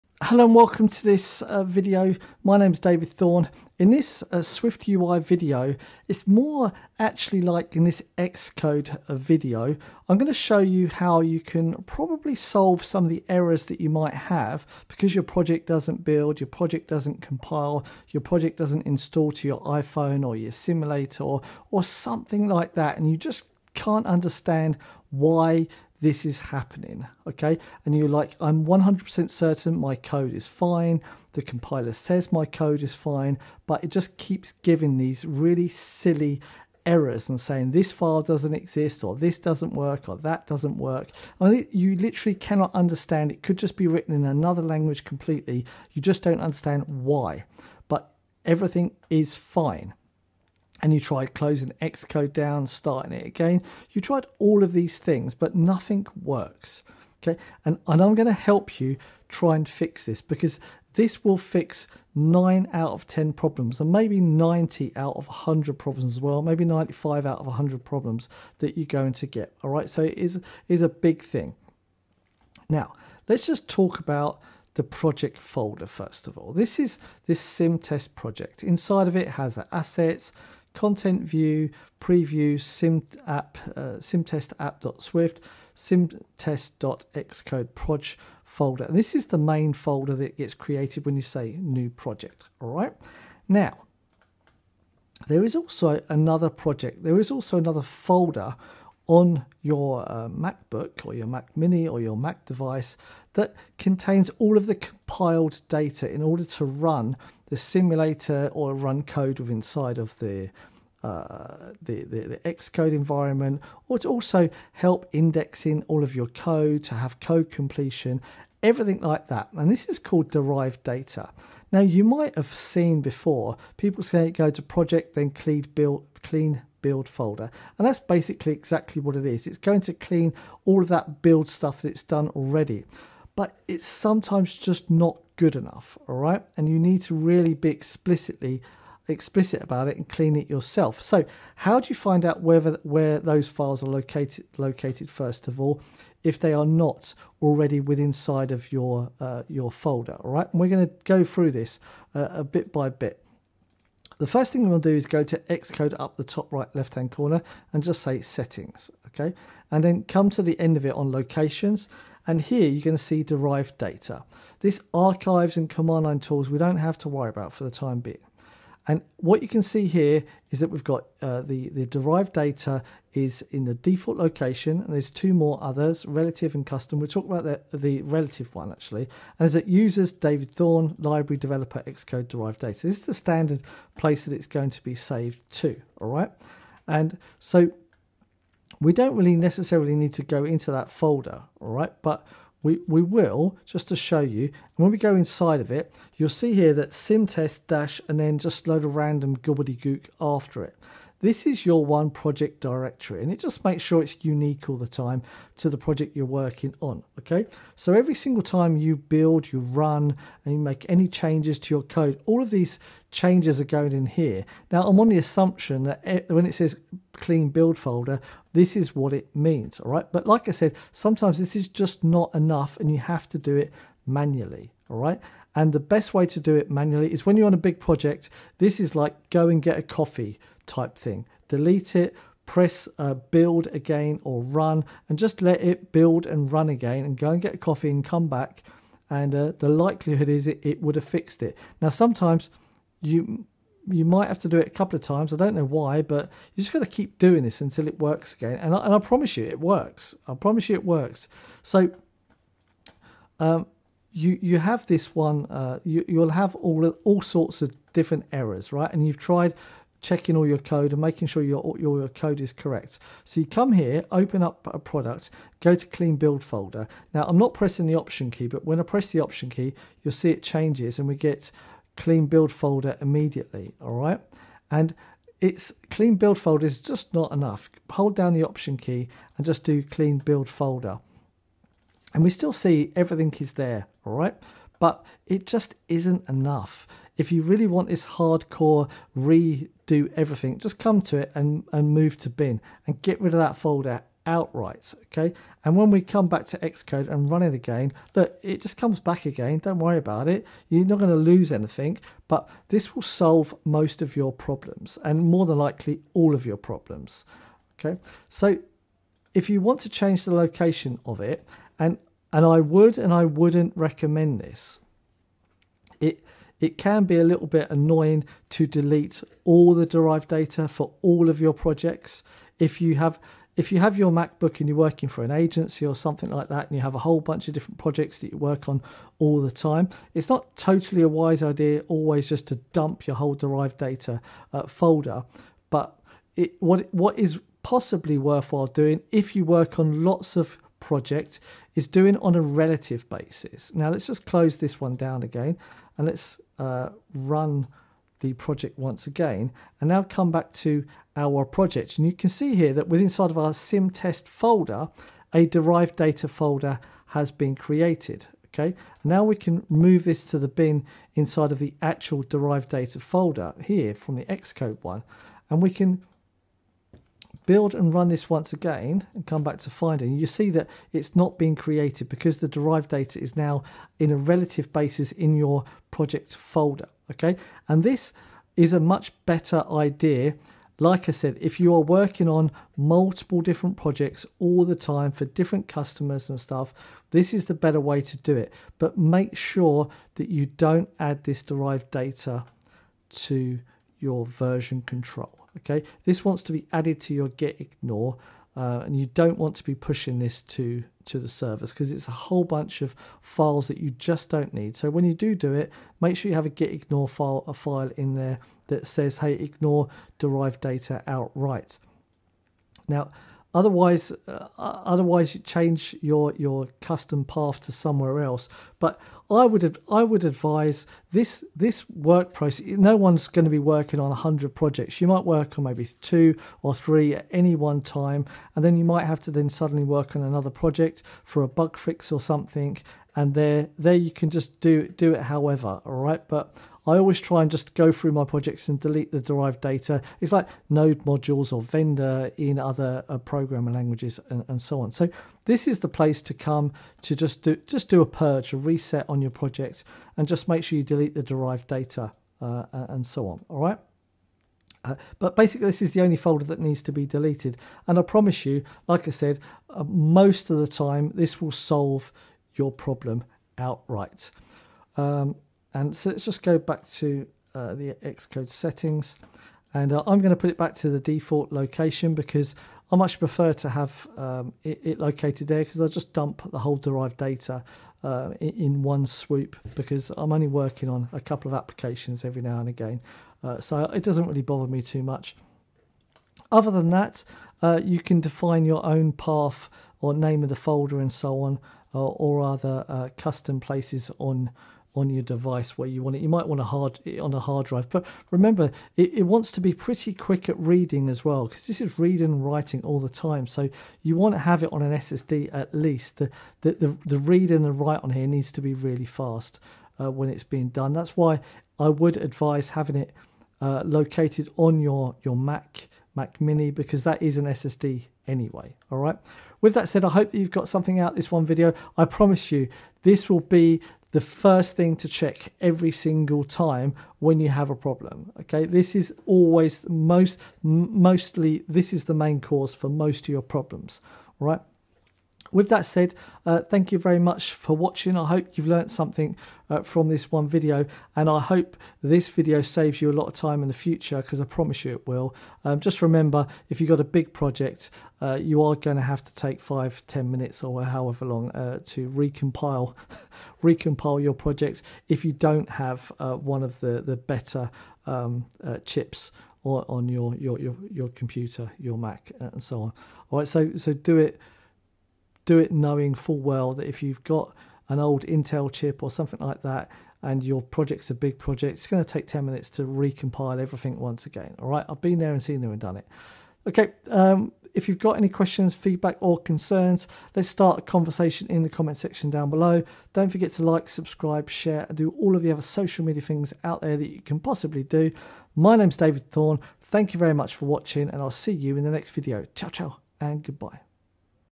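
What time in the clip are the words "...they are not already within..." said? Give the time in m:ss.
2:26.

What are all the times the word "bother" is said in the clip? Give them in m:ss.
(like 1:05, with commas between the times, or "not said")
8:04.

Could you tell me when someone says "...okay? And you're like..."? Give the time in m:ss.
0:27.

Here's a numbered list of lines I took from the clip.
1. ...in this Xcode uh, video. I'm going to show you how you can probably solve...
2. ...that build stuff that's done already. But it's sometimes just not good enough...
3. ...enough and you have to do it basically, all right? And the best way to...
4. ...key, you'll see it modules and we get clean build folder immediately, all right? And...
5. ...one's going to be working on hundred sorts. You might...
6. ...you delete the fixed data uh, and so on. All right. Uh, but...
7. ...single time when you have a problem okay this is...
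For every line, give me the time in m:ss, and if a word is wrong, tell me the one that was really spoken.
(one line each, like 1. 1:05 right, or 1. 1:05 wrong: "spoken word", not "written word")
1. 0:07 right
2. 2:10 right
3. 3:42 wrong: "manually", not "basically"
4. 4:29 wrong: "changes", not "modules"
5. 7:02 wrong: "projects", not "sorts"
6. 7:30 wrong: "derived", not "fixed"
7. 8:45 right.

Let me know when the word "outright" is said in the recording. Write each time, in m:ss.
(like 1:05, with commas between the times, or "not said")
4:54, 6:51, 7:43.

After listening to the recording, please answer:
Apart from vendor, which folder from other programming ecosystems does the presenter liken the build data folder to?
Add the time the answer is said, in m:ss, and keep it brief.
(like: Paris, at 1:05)
Node modules, at 7:20.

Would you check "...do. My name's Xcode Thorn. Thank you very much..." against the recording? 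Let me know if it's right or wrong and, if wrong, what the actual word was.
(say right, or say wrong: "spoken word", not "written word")
wrong: "David", not "Xcode".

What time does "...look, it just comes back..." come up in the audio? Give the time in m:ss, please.
4:58.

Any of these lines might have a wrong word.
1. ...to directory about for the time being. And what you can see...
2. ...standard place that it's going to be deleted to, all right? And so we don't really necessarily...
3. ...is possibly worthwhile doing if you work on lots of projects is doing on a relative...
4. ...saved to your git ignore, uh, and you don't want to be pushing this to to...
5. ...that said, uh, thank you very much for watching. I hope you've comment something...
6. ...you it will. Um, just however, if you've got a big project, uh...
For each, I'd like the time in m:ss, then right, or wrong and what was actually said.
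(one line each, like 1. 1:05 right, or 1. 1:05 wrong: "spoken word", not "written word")
1. 2:46 wrong: "worry", not "directory"
2. 3:03 wrong: "saved", not "deleted"
3. 5:37 right
4. 6:36 wrong: "added", not "saved"
5. 8:55 wrong: "learnt", not "comment"
6. 9:04 wrong: "remember", not "however".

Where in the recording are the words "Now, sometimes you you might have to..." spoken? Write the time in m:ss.
4:01.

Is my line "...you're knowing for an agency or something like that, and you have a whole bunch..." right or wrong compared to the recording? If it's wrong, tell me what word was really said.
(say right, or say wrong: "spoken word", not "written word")
wrong: "working", not "knowing".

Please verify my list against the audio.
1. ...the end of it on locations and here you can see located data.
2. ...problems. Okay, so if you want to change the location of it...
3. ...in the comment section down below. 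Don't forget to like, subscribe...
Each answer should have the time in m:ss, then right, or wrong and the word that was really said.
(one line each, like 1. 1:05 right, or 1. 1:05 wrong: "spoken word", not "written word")
1. 2:40 wrong: "derived", not "located"
2. 5:06 right
3. 9:41 right.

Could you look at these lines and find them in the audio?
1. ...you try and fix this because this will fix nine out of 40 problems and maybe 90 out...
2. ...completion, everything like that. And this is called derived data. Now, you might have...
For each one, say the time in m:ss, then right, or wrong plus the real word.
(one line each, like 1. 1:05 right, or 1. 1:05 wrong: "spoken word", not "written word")
1. 0:58 wrong: "10", not "40"
2. 1:57 right.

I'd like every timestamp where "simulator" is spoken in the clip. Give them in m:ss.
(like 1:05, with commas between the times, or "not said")
0:20, 1:47.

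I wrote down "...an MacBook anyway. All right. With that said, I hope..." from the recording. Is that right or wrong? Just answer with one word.
wrong.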